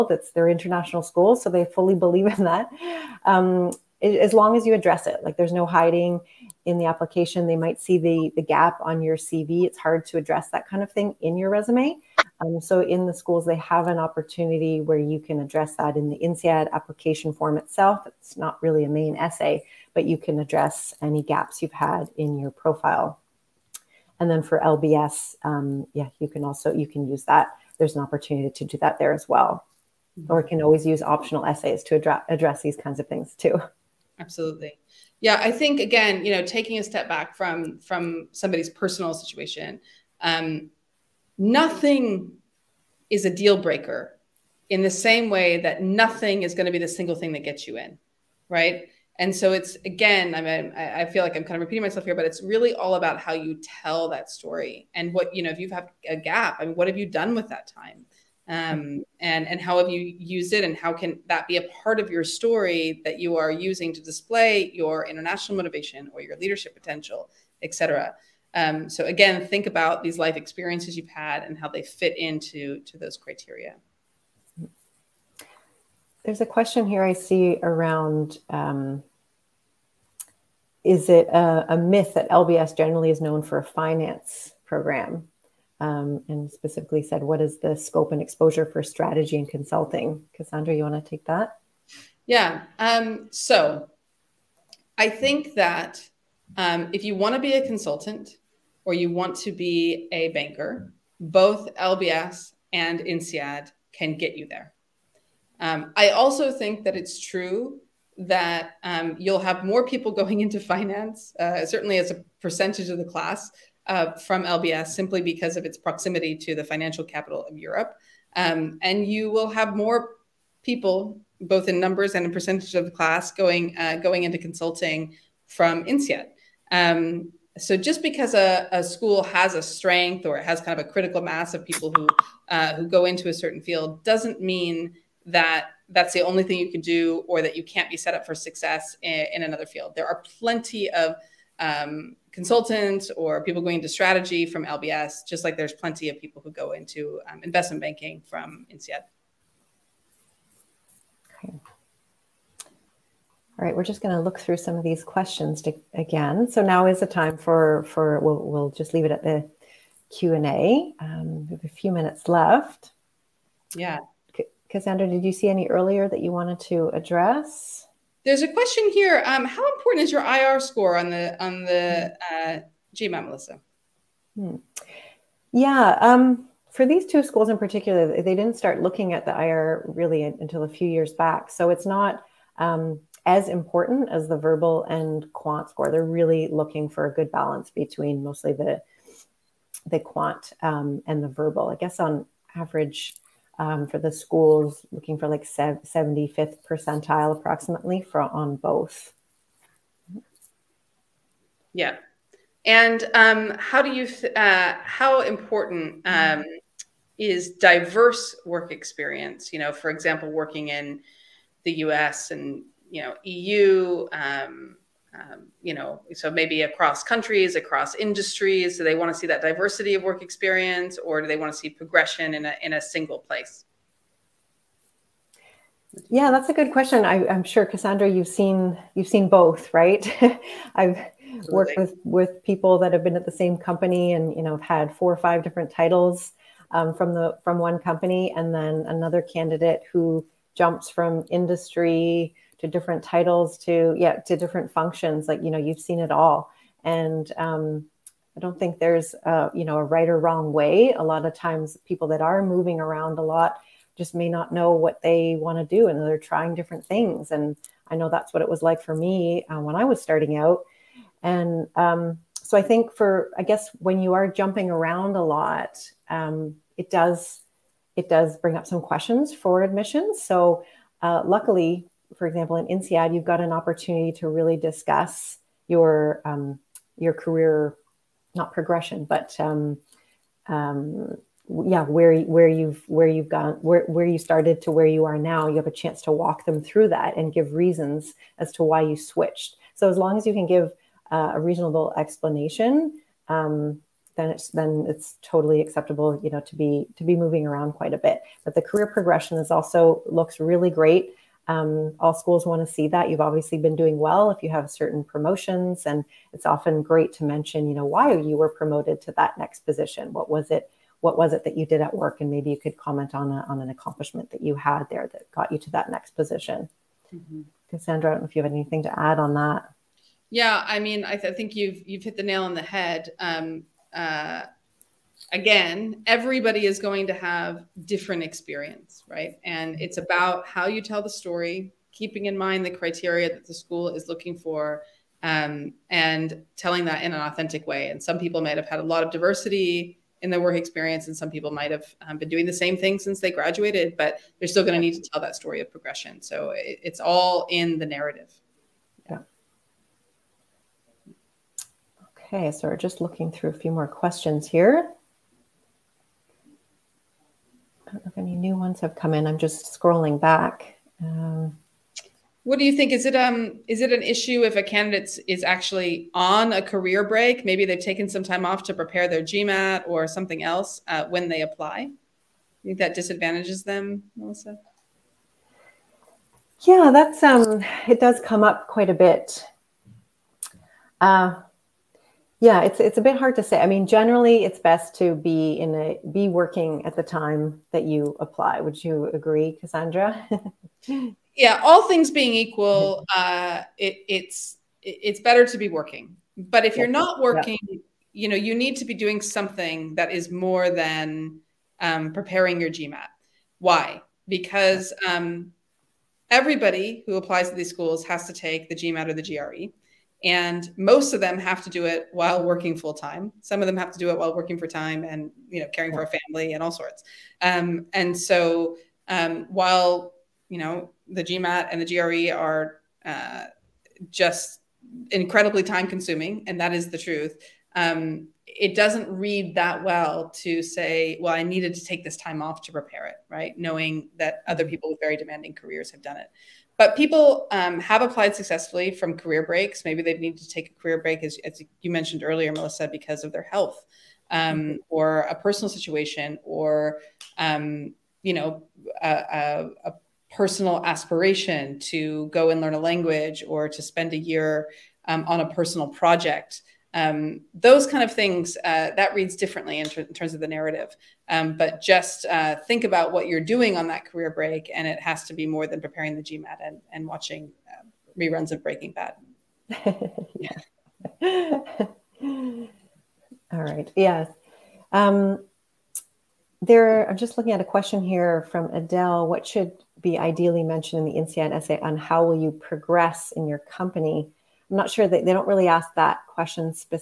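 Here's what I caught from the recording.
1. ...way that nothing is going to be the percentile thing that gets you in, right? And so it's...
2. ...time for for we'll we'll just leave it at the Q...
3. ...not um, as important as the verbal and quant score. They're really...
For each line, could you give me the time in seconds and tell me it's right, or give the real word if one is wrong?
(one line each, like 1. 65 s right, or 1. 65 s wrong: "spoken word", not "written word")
1. 45 s wrong: "single", not "percentile"
2. 157 s right
3. 181 s right.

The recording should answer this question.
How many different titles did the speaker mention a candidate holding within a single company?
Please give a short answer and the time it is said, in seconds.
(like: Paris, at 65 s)
Four or five, at 234 s.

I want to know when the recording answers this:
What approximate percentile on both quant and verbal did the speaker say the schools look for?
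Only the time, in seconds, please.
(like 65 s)
195 s.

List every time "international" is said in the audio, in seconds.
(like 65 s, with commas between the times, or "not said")
0 s, 65 s.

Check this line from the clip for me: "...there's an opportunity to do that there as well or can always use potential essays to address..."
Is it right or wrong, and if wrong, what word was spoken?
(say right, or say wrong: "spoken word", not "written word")
wrong: "optional", not "potential".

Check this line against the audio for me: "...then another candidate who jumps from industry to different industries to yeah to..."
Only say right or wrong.
wrong.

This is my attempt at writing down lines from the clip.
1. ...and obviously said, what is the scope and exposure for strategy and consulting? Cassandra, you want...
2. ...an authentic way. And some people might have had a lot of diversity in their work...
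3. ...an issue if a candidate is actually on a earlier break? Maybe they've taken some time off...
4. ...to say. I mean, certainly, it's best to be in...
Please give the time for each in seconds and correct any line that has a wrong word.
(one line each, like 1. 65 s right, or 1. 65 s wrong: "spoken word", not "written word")
1. 86 s wrong: "specifically", not "obviously"
2. 337 s right
3. 363 s wrong: "career", not "earlier"
4. 383 s wrong: "generally", not "certainly".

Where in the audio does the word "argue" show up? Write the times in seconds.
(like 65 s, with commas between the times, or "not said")
not said.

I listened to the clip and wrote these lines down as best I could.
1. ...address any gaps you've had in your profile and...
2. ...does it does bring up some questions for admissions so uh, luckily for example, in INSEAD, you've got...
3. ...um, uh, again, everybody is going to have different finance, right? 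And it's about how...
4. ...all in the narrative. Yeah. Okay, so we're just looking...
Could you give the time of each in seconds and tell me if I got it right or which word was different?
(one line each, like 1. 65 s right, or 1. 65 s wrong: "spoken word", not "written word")
1. 20 s right
2. 266 s right
3. 323 s wrong: "experience", not "finance"
4. 347 s right.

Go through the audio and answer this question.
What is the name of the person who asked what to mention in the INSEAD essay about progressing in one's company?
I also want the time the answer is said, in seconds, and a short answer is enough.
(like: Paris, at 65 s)
Adele, at 478 s.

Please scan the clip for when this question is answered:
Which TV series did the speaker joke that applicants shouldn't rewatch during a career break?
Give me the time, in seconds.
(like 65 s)
468 s.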